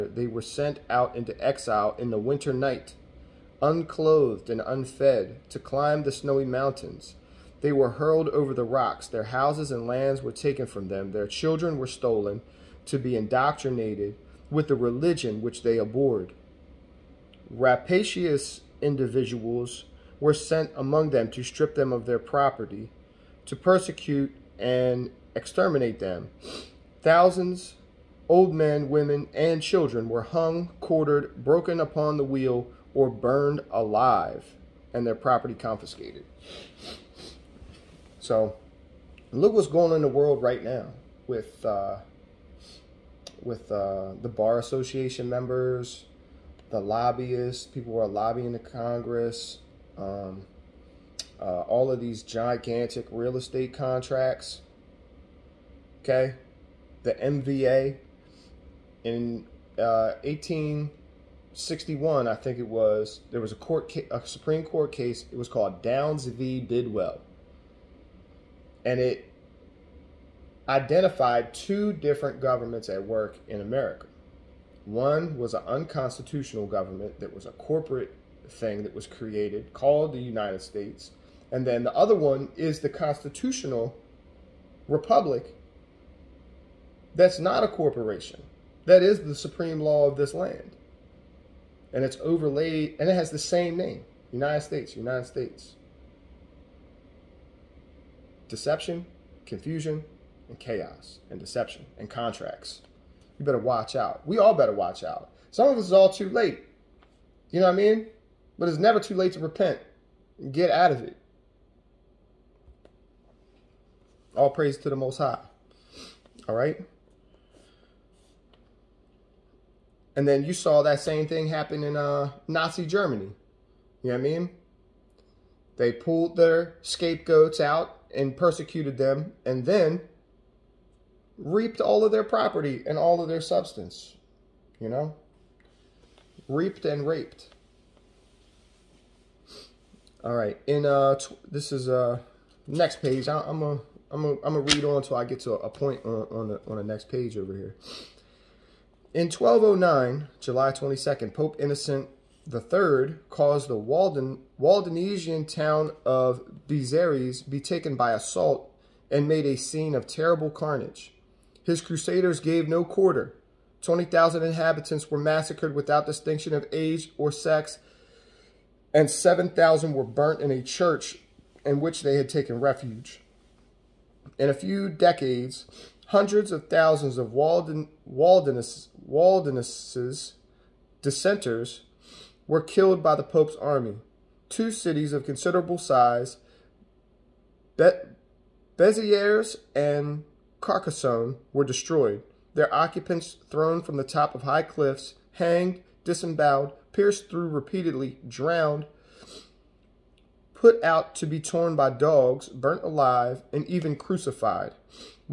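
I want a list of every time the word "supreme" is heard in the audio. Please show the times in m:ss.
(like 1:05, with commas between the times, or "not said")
1:04, 1:29.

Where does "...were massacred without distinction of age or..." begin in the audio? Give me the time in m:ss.
2:45.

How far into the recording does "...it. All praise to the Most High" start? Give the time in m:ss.
1:51.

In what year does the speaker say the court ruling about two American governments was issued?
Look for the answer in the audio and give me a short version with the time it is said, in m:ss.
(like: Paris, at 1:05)
1861, at 1:00.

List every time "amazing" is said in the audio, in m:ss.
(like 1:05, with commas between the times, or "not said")
not said.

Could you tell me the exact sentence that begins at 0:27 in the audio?
Thousands, old men, women, and children were hung, quartered, broken upon the wheel, or burned alive, and their property confiscated.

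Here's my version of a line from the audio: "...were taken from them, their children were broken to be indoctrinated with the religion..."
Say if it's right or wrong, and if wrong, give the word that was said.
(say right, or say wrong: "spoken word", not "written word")
wrong: "stolen", not "broken".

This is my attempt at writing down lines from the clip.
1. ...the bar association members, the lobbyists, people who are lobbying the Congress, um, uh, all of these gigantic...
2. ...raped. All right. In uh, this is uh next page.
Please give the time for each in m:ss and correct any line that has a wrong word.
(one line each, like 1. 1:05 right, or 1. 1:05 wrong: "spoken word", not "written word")
1. 0:44 right
2. 2:17 right.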